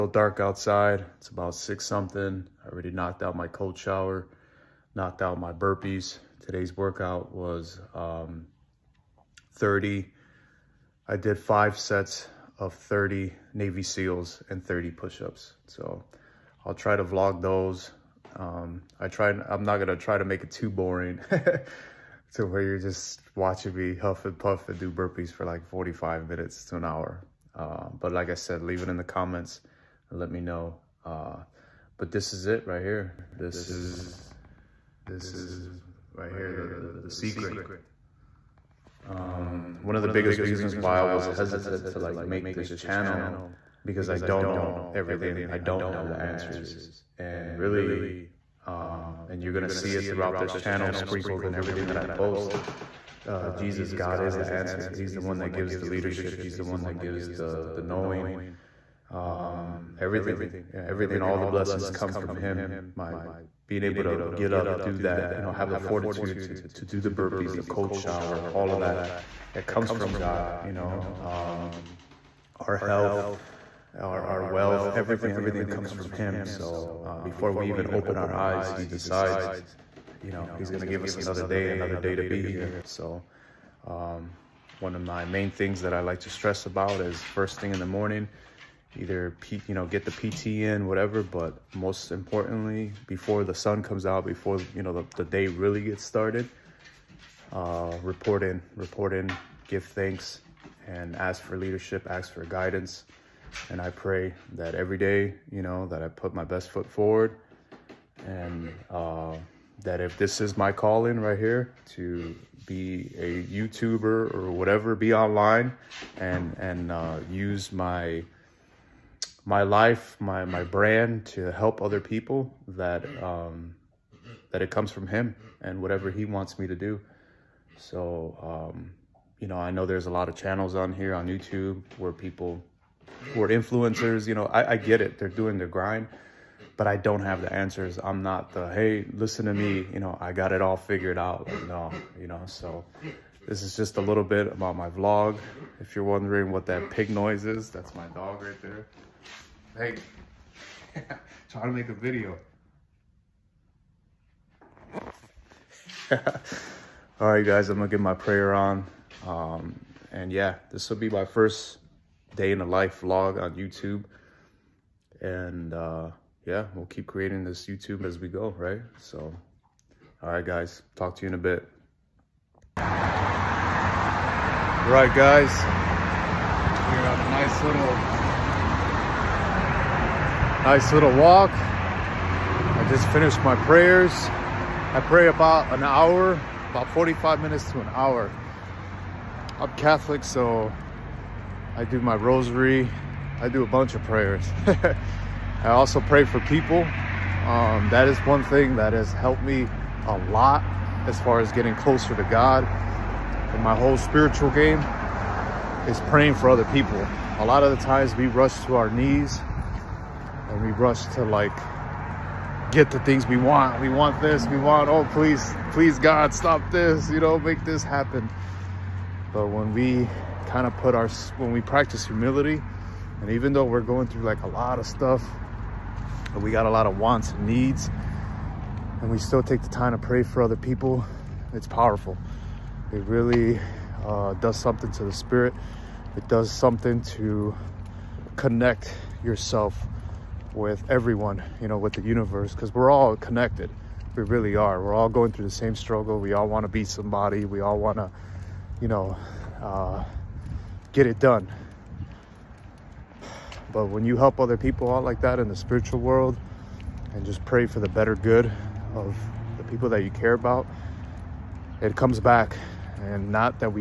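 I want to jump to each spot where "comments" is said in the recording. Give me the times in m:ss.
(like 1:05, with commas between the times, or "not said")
0:29.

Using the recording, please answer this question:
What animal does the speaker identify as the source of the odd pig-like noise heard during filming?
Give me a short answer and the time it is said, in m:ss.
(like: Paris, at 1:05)
dog, at 2:27.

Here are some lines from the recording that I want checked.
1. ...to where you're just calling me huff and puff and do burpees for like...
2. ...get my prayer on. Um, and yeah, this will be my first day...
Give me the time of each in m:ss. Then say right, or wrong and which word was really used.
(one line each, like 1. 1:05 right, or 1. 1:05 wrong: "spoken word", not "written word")
1. 0:21 wrong: "watching", not "calling"
2. 2:37 right.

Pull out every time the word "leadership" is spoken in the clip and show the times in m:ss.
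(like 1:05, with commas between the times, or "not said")
0:55, 1:41.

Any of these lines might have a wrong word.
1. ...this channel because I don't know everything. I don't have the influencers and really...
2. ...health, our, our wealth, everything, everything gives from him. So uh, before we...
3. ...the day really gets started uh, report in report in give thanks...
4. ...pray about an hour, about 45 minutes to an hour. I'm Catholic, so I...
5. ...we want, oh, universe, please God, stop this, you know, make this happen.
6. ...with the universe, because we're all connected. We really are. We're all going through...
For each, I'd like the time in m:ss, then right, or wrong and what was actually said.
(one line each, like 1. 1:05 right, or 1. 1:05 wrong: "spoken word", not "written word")
1. 0:42 wrong: "answers", not "influencers"
2. 1:12 wrong: "comes", not "gives"
3. 1:35 right
4. 3:05 right
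5. 3:34 wrong: "please", not "universe"
6. 4:01 right.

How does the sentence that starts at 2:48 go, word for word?
So, all right, guys, talk to you in a bit.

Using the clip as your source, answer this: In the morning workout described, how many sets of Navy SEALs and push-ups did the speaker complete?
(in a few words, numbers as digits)
5.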